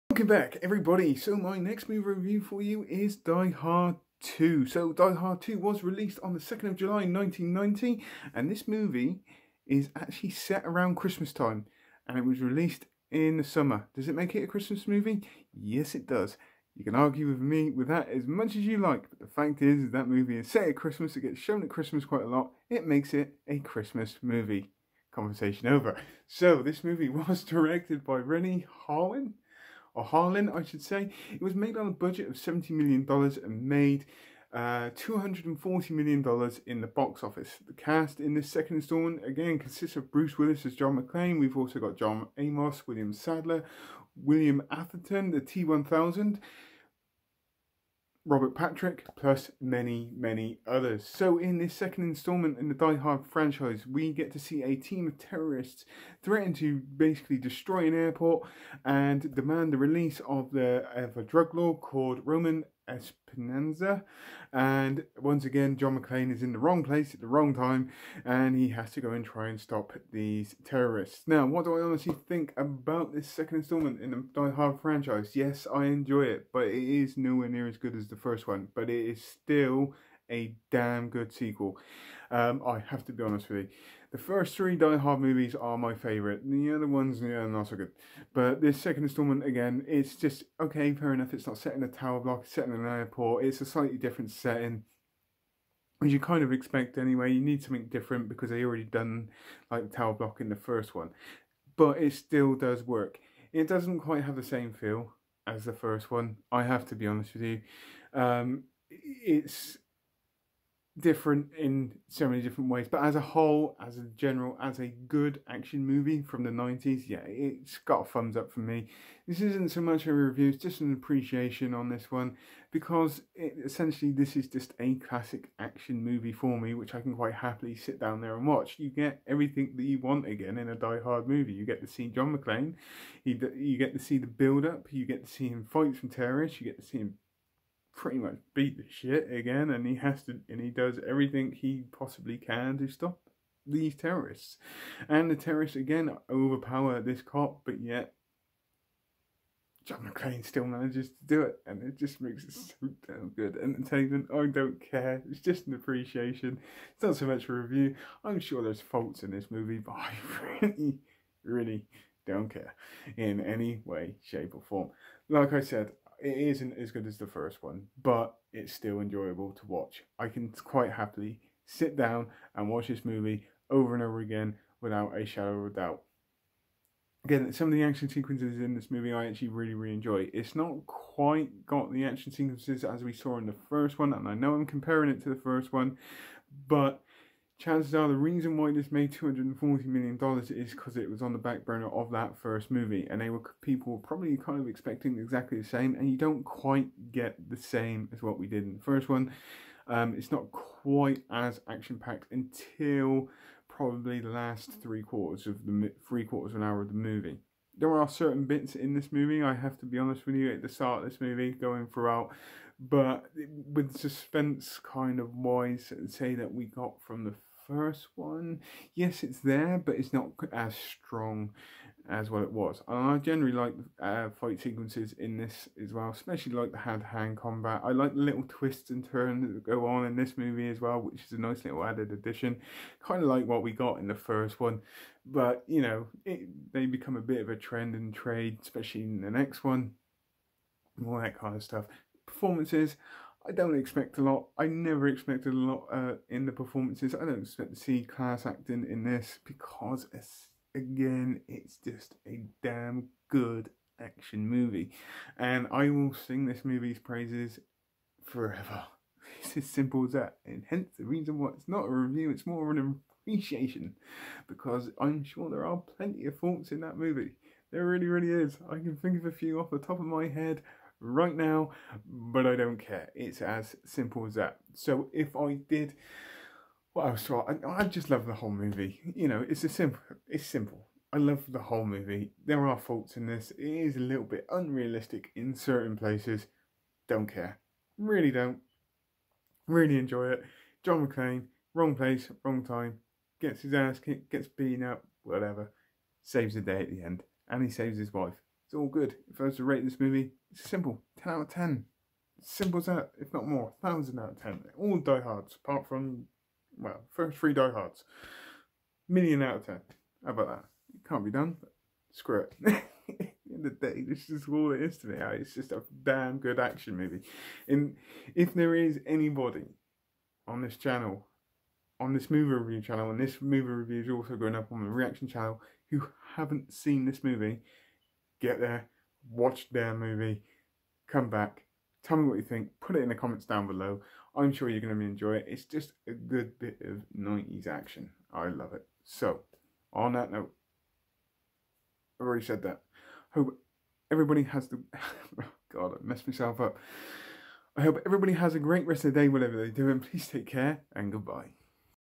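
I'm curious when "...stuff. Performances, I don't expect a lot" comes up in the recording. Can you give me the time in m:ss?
4:01.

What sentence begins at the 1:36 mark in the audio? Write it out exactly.
As you kind of expect anyway, you need something different because they already done like the tower block in the first one.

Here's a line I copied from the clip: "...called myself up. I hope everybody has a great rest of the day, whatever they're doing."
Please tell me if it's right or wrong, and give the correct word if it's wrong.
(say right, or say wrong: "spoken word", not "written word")
wrong: "messed", not "called".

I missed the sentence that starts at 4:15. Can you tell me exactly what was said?
And I will sing this movie's praises forever.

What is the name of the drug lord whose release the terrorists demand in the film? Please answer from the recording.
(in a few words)
Roman Esperanza.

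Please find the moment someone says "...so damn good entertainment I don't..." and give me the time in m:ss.
2:32.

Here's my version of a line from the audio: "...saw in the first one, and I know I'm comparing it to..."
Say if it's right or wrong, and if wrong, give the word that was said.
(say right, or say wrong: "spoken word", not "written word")
right.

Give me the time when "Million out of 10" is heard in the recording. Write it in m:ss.
5:09.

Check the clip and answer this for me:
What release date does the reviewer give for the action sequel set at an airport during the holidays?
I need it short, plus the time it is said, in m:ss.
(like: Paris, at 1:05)
2nd of July 1990, at 0:06.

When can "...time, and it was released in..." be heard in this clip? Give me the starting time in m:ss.
0:11.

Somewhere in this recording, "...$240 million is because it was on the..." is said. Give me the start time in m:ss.
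3:09.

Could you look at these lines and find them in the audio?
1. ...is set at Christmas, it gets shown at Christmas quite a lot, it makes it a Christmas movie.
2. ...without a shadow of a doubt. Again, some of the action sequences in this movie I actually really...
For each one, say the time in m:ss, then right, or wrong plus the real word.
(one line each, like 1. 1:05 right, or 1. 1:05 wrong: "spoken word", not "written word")
1. 0:20 right
2. 2:54 right.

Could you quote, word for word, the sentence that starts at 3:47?
I like the little twists and turns that go on in this movie as well, which is a nice little added addition.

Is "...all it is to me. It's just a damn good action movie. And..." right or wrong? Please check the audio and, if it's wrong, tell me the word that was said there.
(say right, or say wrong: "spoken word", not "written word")
right.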